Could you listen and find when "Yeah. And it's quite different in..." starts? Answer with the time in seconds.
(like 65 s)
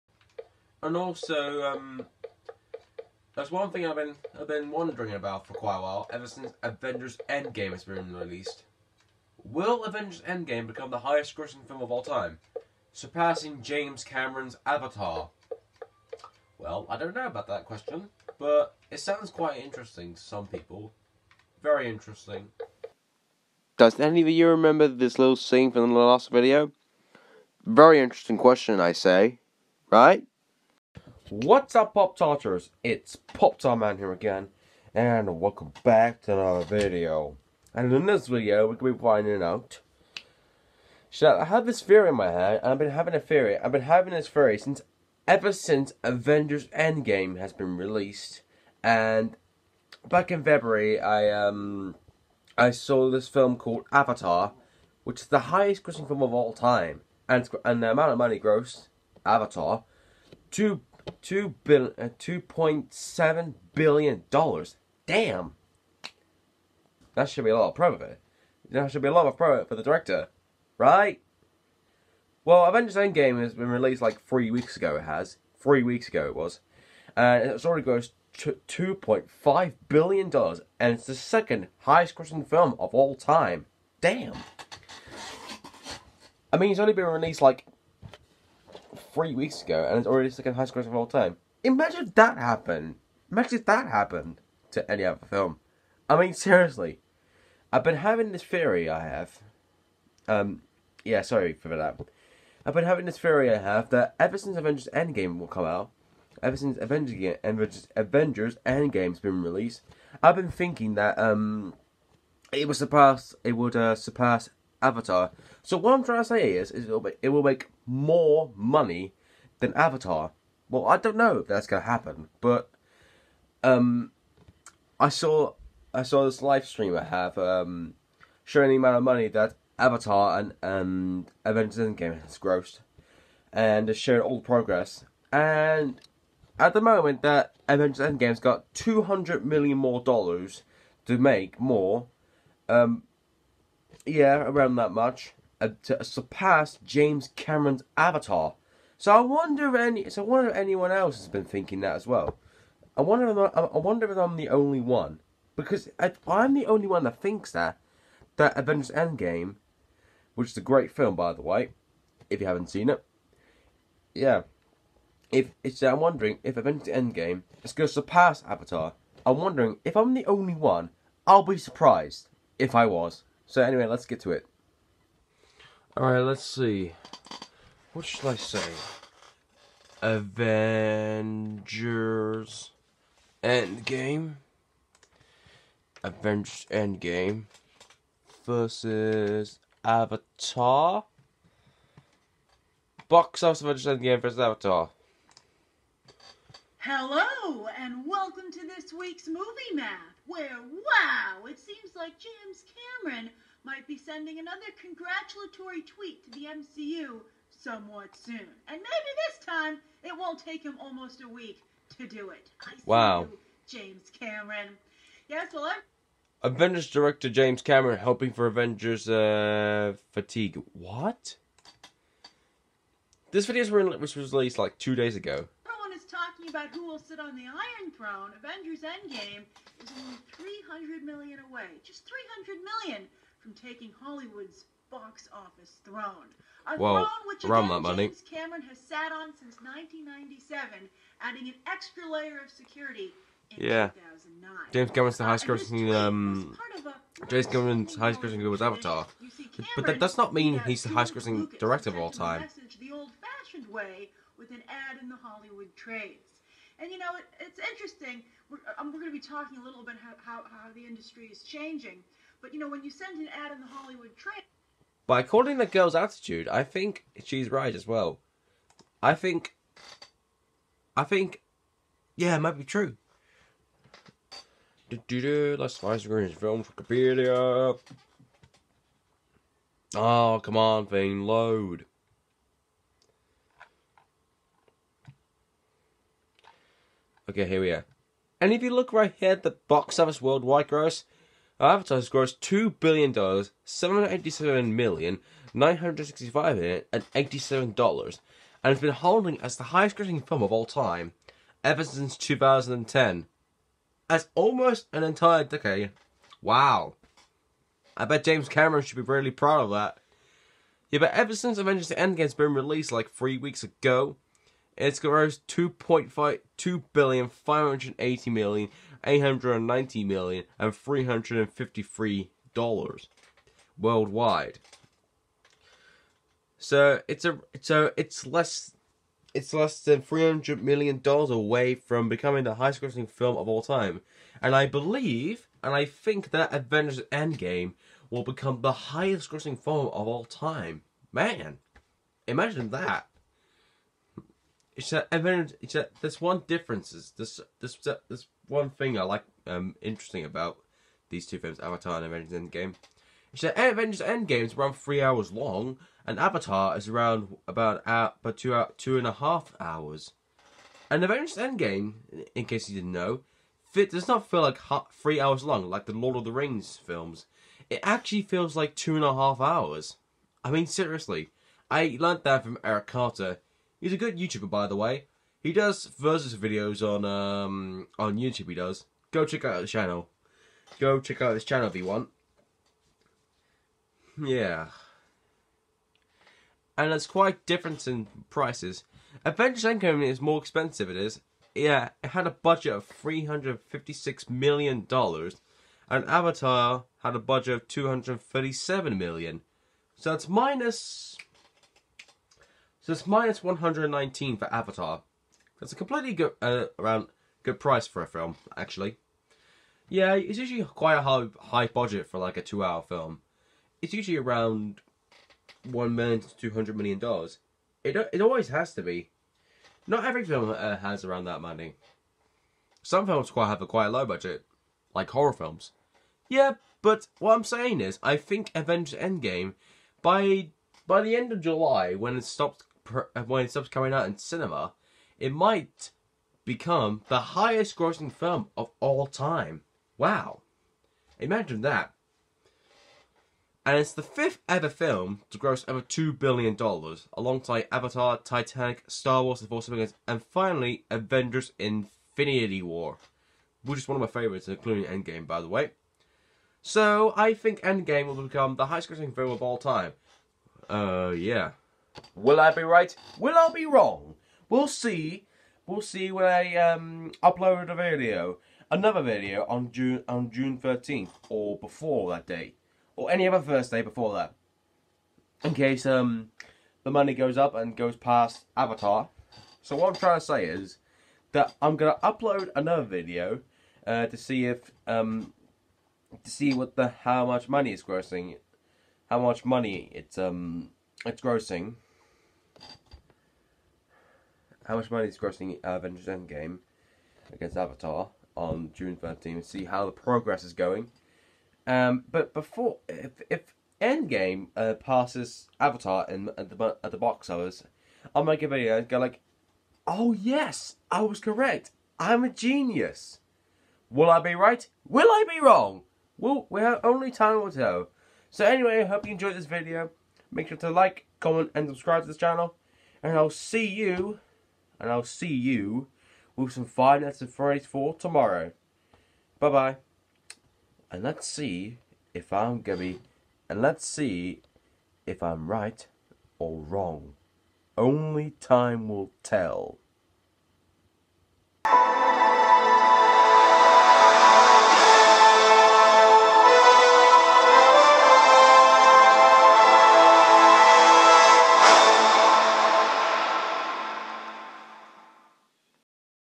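384 s.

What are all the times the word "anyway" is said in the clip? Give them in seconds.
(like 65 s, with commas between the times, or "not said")
173 s, 518 s.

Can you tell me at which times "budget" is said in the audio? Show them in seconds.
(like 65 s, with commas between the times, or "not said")
392 s, 397 s, 411 s, 424 s.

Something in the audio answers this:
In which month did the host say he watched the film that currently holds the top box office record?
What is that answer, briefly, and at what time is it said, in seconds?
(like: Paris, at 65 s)
February, at 50 s.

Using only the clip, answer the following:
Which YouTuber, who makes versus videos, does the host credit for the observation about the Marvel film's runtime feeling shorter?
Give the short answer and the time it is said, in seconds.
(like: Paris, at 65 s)
Eric Carter, at 372 s.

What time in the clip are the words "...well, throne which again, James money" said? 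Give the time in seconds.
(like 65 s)
236 s.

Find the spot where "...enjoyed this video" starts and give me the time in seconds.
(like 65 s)
519 s.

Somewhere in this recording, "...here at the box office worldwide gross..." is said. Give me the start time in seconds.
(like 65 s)
289 s.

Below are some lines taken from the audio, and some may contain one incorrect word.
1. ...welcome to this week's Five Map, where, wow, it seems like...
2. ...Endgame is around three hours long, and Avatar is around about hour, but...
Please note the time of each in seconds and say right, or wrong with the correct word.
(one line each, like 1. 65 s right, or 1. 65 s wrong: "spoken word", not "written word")
1. 198 s wrong: "Movie", not "Five"
2. 354 s right.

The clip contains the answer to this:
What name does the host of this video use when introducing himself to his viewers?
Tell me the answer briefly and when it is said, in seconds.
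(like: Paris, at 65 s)
Pop Tart Man, at 33 s.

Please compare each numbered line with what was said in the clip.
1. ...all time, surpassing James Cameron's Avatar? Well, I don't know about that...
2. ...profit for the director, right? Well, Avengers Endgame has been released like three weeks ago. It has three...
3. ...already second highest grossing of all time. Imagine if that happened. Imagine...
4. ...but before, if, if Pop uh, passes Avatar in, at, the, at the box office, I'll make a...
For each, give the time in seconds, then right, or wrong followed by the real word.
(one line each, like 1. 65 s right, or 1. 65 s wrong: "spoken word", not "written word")
1. 11 s right
2. 69 s right
3. 90 s right
4. 502 s wrong: "Endgame", not "Pop".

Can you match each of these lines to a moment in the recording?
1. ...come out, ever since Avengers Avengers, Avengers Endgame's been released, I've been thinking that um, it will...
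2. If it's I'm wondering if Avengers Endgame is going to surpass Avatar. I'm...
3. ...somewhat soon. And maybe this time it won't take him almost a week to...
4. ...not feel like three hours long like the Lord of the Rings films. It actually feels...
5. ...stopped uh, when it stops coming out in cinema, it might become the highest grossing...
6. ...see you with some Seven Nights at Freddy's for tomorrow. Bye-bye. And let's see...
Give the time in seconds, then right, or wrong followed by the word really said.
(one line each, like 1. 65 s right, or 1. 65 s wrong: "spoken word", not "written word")
1. 105 s right
2. 165 s right
3. 207 s right
4. 364 s right
5. 432 s right
6. 525 s wrong: "Five", not "Seven".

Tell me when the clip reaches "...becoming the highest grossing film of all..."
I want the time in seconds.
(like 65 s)
332 s.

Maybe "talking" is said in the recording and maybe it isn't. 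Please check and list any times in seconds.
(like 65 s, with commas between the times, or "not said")
226 s, 259 s.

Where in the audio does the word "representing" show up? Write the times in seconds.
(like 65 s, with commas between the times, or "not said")
not said.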